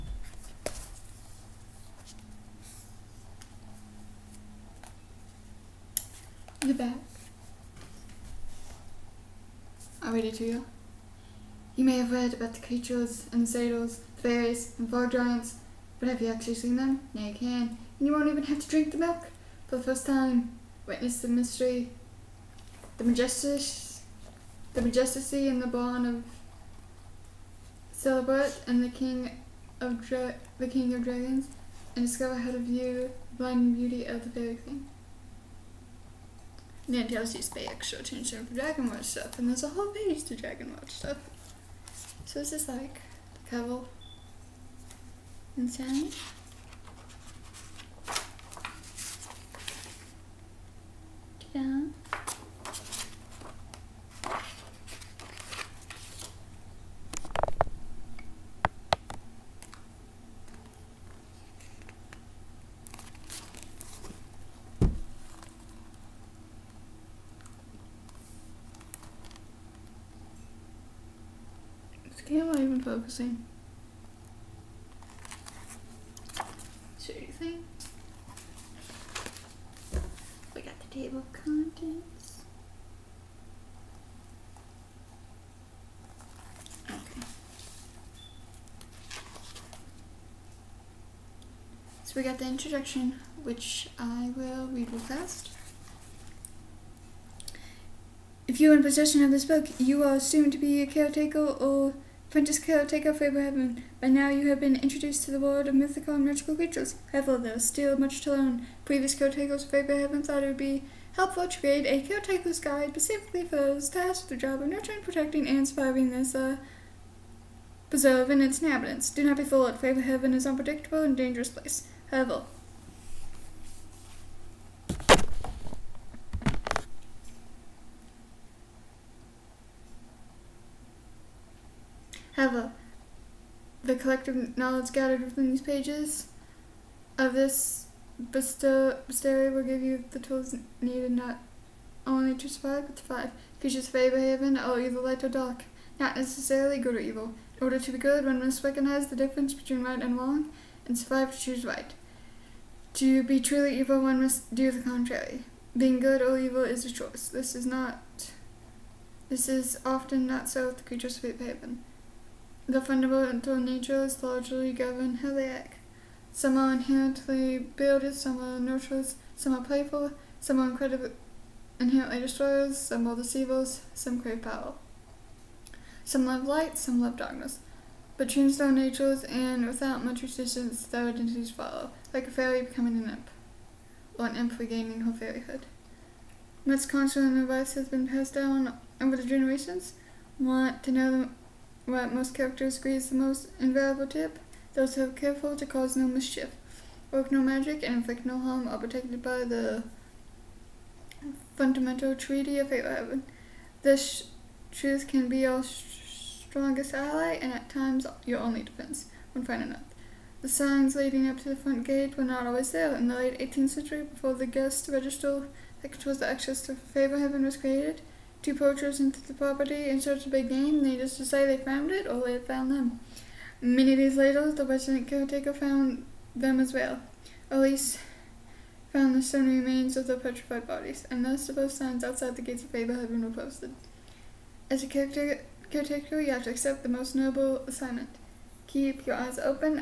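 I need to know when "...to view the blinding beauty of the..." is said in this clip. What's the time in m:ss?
0:32.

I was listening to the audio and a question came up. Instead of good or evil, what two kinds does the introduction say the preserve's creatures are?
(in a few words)
light or dark.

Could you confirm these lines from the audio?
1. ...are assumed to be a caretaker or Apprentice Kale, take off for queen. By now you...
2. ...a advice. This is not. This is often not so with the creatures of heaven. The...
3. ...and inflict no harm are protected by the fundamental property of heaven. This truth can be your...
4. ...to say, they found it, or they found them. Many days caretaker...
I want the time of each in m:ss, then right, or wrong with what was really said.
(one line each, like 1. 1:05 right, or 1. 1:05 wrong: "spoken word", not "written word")
1. 1:40 wrong: "heaven", not "queen"
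2. 2:36 wrong: "choice", not "advice"
3. 3:17 wrong: "treaty", not "property"
4. 3:41 wrong: "later", not "caretaker".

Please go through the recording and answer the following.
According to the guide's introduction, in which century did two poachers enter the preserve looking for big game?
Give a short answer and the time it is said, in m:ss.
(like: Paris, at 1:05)
late 18th century, at 3:33.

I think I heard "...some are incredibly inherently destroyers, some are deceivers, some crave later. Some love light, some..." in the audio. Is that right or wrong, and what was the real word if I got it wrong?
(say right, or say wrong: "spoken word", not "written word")
wrong: "power", not "later".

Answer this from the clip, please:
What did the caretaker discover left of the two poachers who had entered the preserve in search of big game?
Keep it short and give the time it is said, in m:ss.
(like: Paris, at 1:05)
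stone remains, at 3:49.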